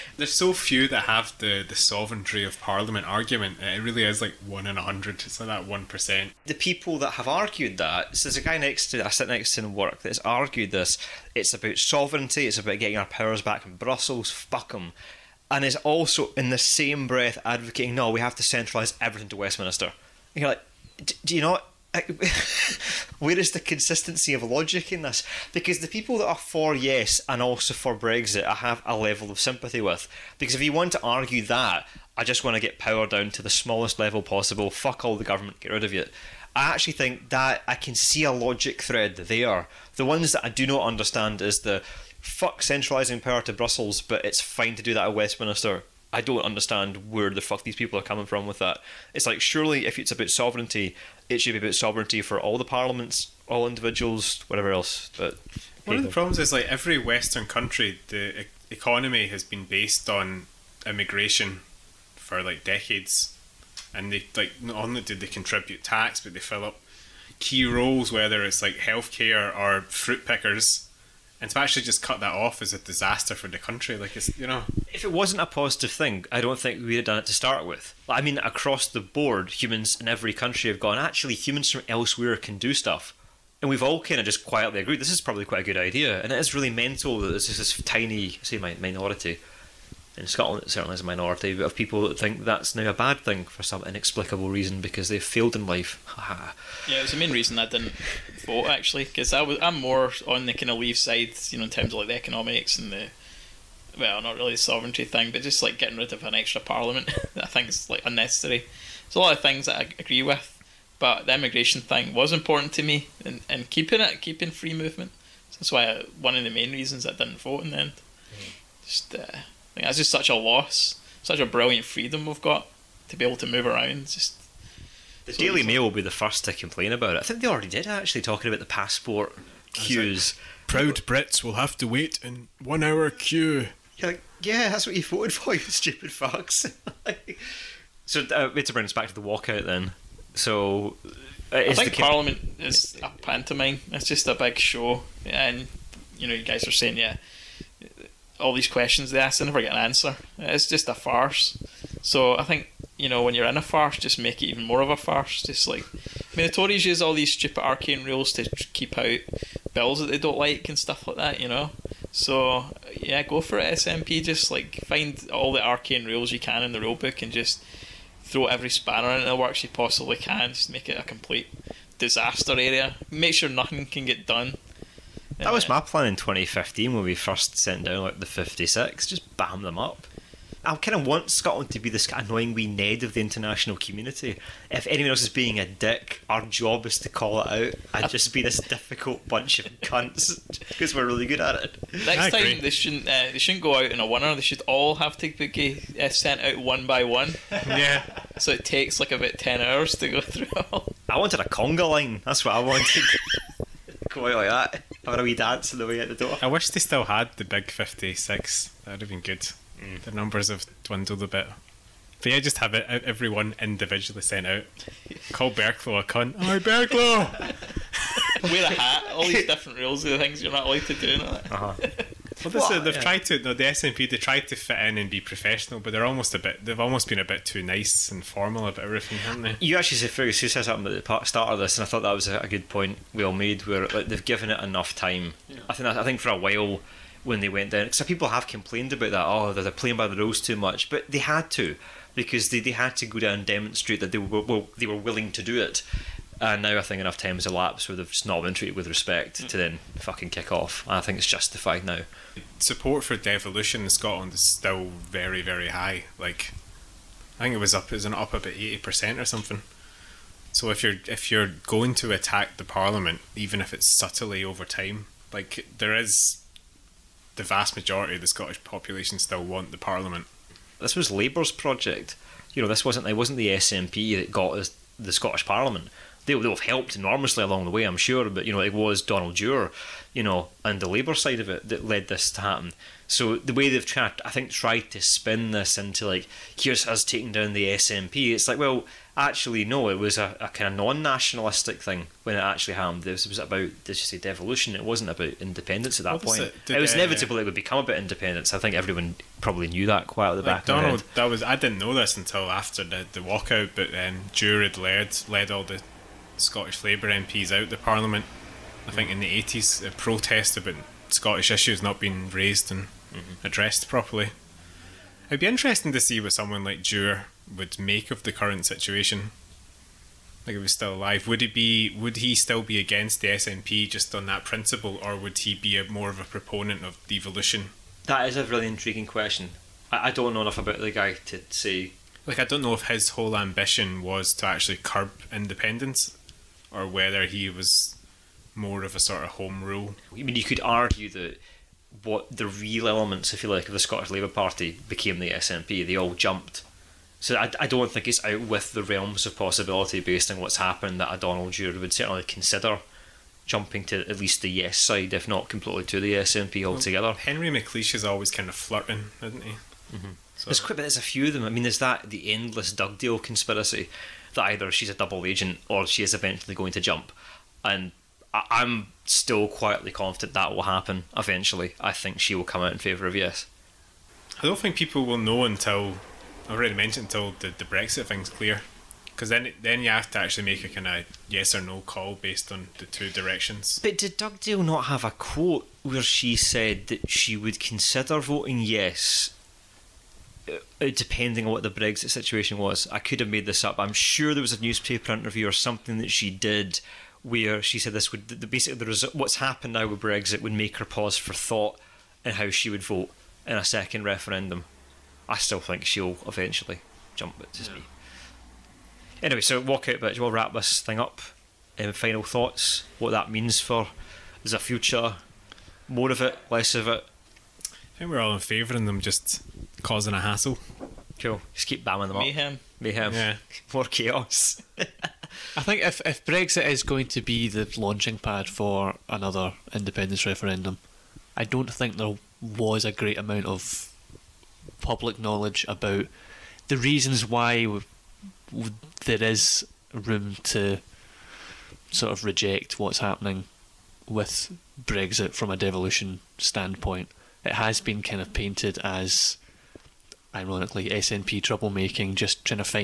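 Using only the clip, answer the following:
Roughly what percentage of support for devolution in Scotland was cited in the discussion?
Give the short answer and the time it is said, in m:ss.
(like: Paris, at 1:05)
80%, at 4:18.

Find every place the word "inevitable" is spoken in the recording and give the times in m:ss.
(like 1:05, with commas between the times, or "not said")
4:56.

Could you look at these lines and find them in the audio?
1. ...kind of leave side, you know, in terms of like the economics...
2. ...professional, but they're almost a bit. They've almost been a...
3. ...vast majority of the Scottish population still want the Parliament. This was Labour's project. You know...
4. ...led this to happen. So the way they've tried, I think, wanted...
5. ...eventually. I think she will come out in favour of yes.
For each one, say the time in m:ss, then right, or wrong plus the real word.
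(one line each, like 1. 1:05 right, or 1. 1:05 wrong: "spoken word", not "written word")
1. 1:40 right
2. 3:45 right
3. 4:27 right
4. 4:41 wrong: "tried", not "wanted"
5. 6:11 right.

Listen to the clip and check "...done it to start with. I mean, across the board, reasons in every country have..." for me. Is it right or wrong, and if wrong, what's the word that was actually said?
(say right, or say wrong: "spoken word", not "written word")
wrong: "humans", not "reasons".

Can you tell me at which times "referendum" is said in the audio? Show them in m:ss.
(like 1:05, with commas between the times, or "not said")
6:44, 7:10.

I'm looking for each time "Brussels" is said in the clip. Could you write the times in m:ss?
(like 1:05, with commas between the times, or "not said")
0:13, 0:43.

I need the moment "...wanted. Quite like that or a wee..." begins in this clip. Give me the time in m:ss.
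3:22.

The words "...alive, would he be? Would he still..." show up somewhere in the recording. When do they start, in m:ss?
5:20.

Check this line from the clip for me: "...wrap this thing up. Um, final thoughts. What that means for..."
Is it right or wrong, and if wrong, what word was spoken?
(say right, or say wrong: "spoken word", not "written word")
right.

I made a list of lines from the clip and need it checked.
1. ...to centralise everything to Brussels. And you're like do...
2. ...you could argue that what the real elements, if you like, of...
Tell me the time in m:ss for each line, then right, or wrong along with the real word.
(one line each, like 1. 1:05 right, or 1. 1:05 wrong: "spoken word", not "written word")
1. 0:18 wrong: "Westminster", not "Brussels"
2. 5:40 right.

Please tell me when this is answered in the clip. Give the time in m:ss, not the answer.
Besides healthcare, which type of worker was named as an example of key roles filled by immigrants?
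1:09.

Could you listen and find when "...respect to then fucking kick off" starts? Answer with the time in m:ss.
4:08.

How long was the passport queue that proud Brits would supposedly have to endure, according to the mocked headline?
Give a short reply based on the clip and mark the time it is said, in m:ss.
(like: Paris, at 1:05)
1 hour, at 2:12.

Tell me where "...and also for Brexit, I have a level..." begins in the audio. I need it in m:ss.
0:27.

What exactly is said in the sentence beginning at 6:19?
Because then, then you have to actually make a kind of yes or no call based on the two directions.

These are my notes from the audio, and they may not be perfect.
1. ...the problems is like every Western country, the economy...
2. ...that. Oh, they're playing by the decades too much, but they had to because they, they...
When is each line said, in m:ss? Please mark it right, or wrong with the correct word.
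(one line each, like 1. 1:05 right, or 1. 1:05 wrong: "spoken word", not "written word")
1. 0:56 right
2. 3:59 wrong: "rules", not "decades".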